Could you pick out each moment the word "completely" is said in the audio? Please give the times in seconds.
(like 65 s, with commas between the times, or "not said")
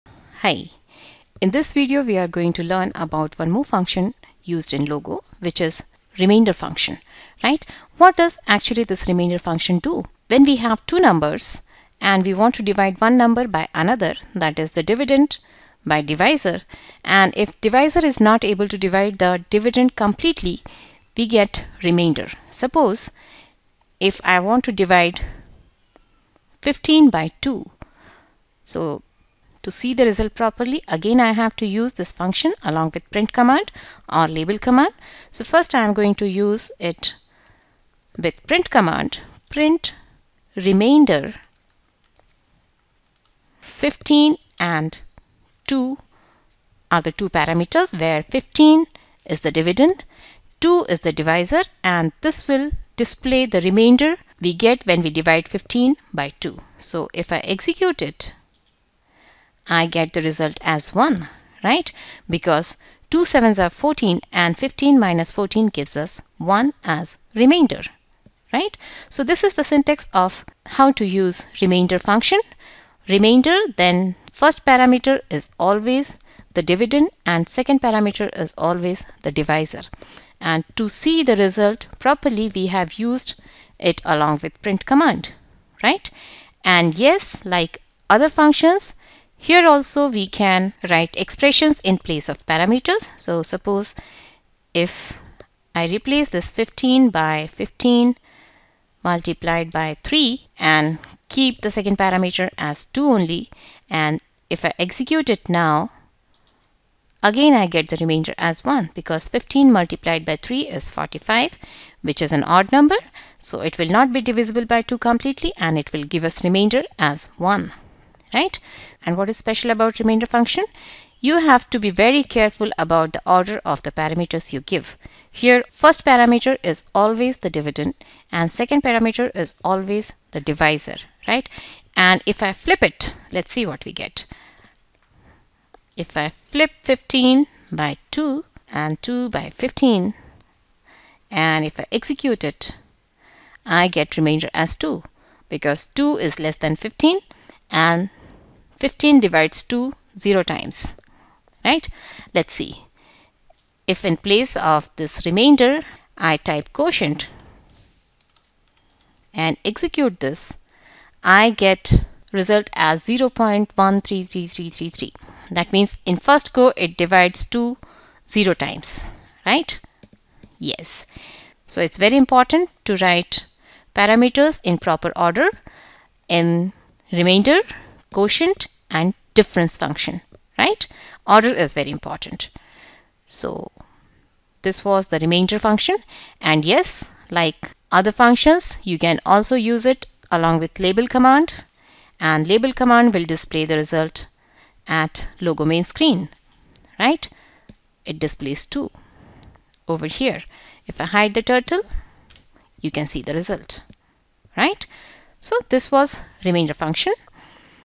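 19 s, 114 s.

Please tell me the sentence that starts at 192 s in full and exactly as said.
And label command will display the result at logo main screen, right?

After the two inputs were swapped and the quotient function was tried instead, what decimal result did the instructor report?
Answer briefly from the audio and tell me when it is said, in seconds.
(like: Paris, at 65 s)
0.133333, at 163 s.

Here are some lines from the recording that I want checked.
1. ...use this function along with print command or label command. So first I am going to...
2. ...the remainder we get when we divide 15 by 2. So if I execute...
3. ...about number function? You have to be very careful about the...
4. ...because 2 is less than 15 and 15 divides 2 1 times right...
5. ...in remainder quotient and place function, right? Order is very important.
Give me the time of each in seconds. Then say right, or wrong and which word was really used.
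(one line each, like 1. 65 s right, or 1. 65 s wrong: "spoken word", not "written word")
1. 31 s right
2. 53 s right
3. 119 s wrong: "remainder", not "number"
4. 145 s wrong: "0", not "1"
5. 176 s wrong: "difference", not "place".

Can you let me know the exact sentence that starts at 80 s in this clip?
And to see the result properly we have used it along with print command, right?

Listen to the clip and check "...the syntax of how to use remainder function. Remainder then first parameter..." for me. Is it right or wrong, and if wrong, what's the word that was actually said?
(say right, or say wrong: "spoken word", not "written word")
right.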